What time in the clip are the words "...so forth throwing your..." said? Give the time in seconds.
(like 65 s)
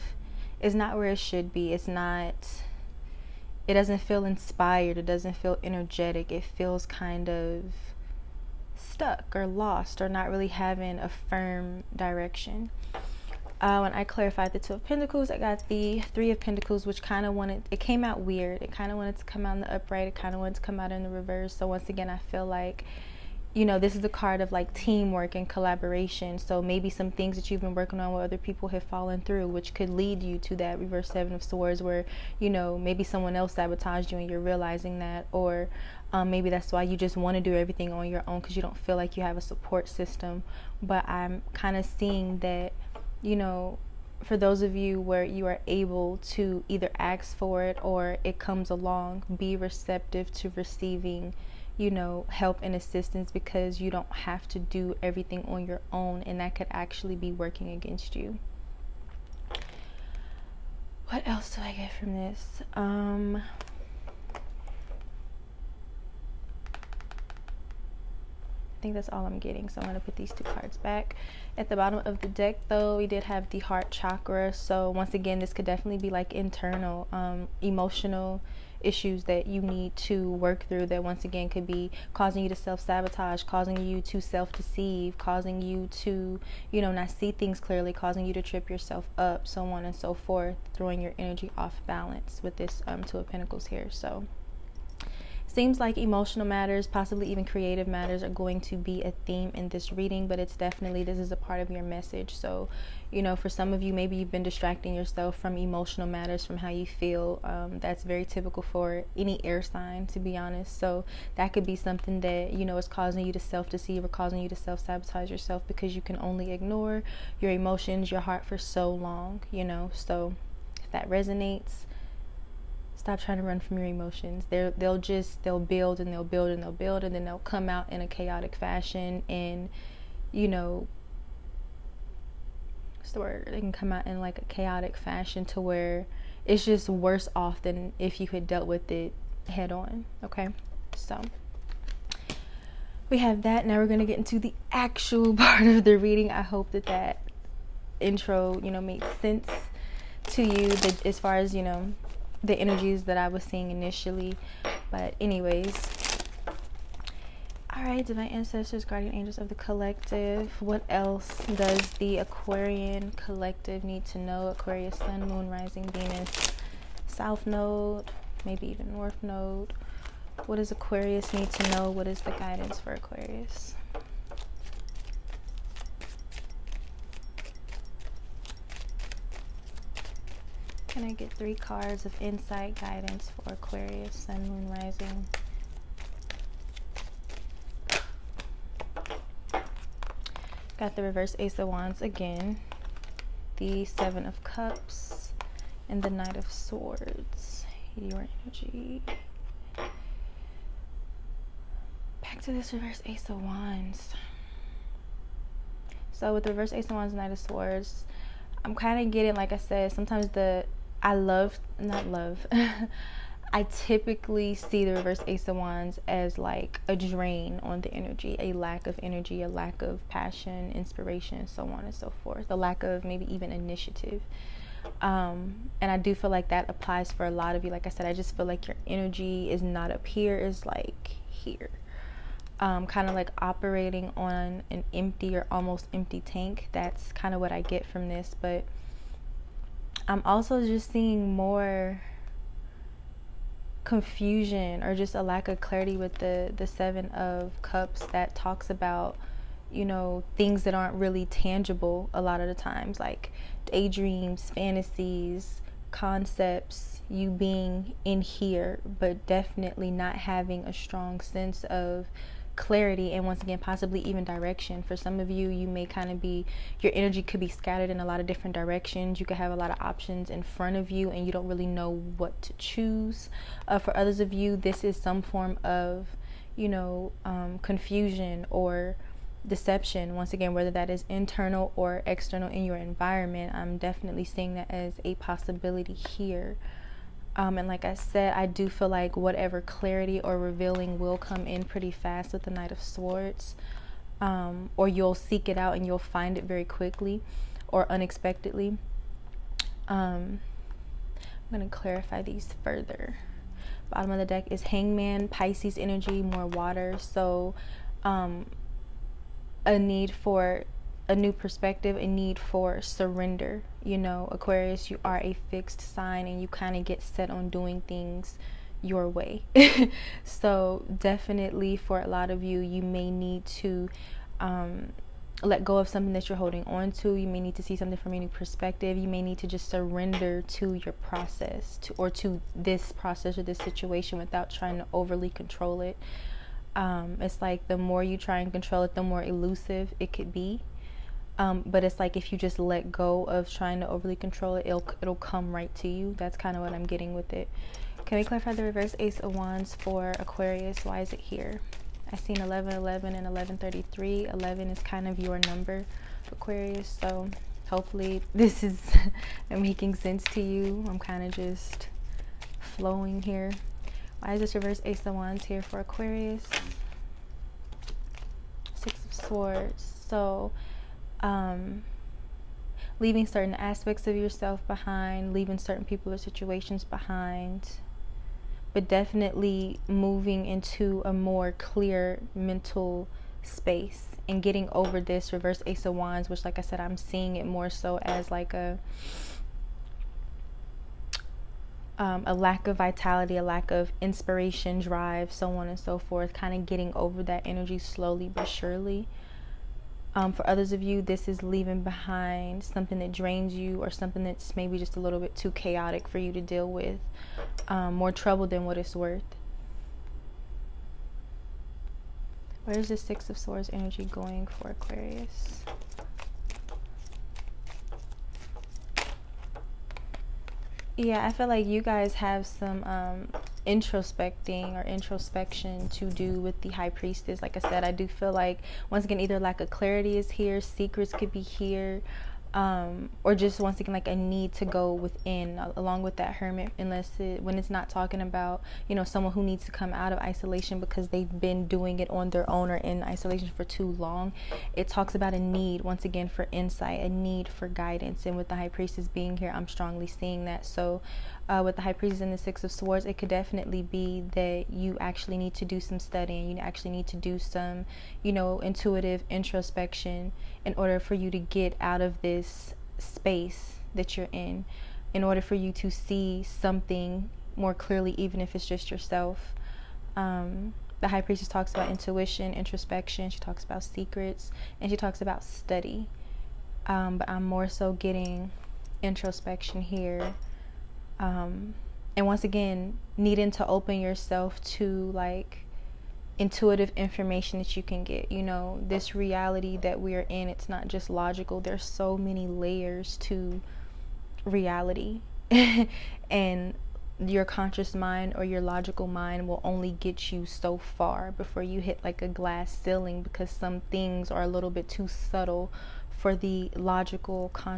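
89 s.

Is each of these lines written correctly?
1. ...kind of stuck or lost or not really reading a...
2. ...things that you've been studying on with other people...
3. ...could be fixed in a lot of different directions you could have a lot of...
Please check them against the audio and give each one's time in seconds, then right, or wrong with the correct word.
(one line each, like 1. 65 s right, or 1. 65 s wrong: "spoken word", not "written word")
1. 6 s wrong: "having", not "reading"
2. 27 s wrong: "working", not "studying"
3. 267 s wrong: "scattered", not "fixed".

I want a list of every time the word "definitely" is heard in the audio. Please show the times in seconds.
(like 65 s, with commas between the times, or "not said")
75 s, 100 s, 259 s, 283 s, 320 s, 378 s, 453 s.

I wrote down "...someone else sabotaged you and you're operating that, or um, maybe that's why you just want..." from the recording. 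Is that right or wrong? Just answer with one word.
wrong.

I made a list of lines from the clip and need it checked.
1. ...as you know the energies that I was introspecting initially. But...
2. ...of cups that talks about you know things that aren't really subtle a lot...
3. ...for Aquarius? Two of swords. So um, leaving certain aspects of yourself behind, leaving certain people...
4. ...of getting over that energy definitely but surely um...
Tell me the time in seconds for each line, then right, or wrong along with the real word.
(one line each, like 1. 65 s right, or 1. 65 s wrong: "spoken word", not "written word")
1. 151 s wrong: "seeing", not "introspecting"
2. 247 s wrong: "tangible", not "subtle"
3. 365 s wrong: "Six", not "Two"
4. 396 s wrong: "slowly", not "definitely".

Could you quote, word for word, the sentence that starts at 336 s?
Um, it's like the more you try and control it, the more elusive it could be.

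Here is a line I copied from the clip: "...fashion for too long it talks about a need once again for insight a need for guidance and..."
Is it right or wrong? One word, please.
wrong.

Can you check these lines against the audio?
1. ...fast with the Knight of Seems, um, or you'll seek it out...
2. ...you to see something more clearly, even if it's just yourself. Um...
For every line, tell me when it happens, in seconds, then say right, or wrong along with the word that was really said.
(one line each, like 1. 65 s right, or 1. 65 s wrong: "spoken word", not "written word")
1. 291 s wrong: "Swords", not "Seems"
2. 465 s right.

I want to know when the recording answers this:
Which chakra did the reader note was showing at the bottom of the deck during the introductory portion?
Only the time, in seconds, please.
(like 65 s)
73 s.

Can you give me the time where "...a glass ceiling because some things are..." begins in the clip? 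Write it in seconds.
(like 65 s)
502 s.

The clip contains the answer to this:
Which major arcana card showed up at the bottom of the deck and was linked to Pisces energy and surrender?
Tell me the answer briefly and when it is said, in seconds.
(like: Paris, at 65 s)
Hangman, at 304 s.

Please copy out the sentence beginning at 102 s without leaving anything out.
So, you know, for some of you, maybe you've been distracting yourself from emotional matters, from how you feel.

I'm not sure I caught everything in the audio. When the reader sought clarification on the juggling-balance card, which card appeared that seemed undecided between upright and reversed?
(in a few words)
Three of Pentacles.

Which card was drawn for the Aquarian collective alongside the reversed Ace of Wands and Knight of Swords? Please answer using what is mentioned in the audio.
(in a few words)
Seven of Cups.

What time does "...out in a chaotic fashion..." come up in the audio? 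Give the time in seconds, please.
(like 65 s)
127 s.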